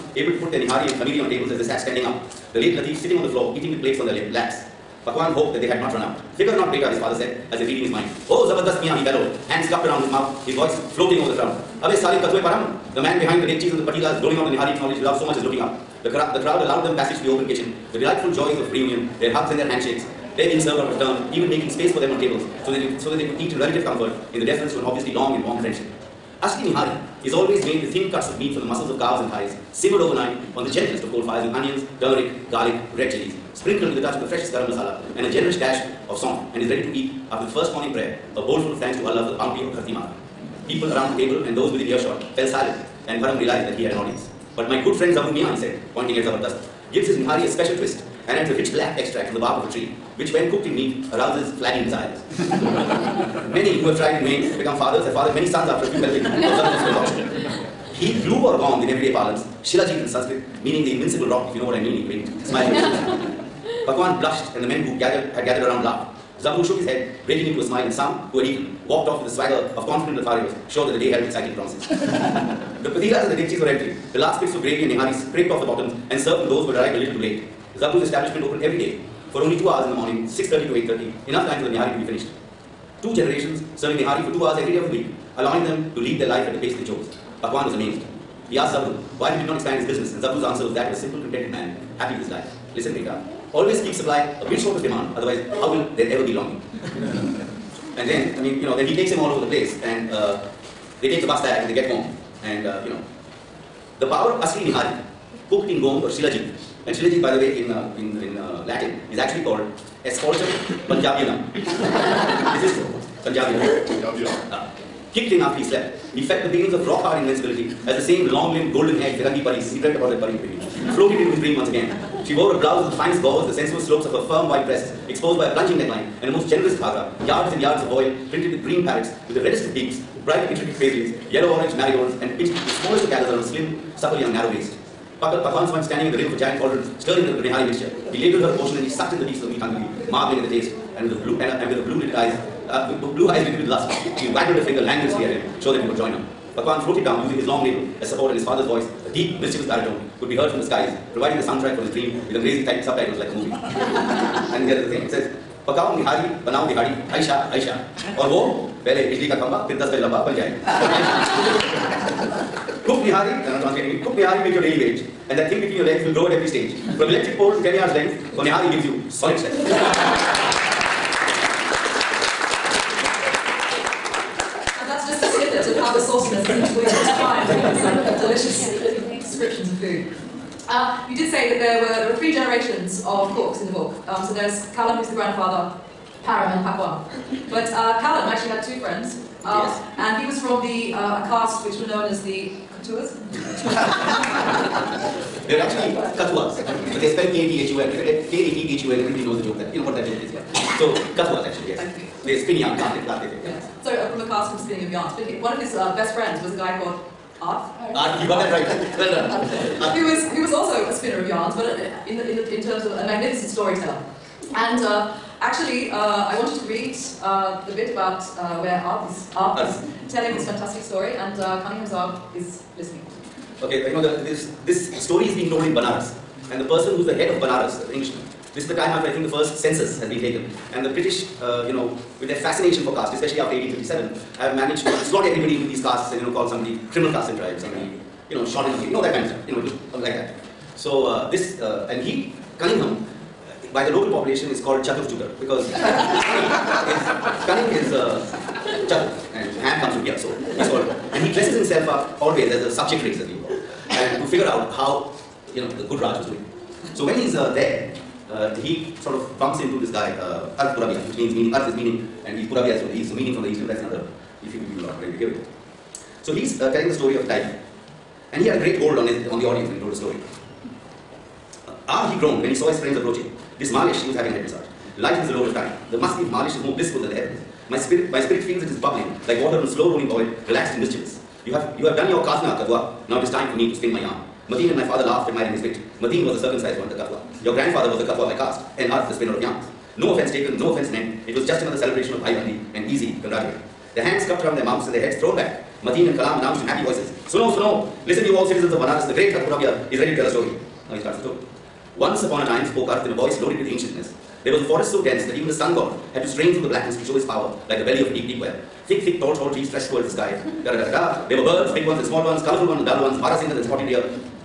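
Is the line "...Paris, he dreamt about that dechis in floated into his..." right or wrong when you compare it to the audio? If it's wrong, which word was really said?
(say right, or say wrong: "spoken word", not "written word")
wrong: "paris", not "dechis".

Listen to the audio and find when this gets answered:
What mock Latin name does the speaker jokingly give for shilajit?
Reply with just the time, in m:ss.
1:50.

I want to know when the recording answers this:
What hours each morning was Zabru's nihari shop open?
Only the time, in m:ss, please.
1:20.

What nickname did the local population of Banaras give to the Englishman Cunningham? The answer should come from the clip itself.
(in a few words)
Chatur Chutar.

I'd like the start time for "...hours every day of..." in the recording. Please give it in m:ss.
1:24.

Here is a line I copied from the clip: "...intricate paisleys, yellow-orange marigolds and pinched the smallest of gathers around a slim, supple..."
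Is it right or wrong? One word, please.
right.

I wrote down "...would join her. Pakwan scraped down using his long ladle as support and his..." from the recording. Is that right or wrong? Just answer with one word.
wrong.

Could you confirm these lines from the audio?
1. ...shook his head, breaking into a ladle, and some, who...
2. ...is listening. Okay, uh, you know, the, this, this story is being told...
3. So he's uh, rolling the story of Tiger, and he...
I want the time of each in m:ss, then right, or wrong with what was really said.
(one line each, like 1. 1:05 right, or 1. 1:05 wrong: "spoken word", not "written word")
1. 1:06 wrong: "smile", not "ladle"
2. 3:42 right
3. 4:26 wrong: "telling", not "rolling".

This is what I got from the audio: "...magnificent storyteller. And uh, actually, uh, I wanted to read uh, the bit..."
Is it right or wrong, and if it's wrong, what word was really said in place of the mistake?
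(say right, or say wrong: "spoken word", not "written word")
right.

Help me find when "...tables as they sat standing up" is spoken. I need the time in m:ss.
0:01.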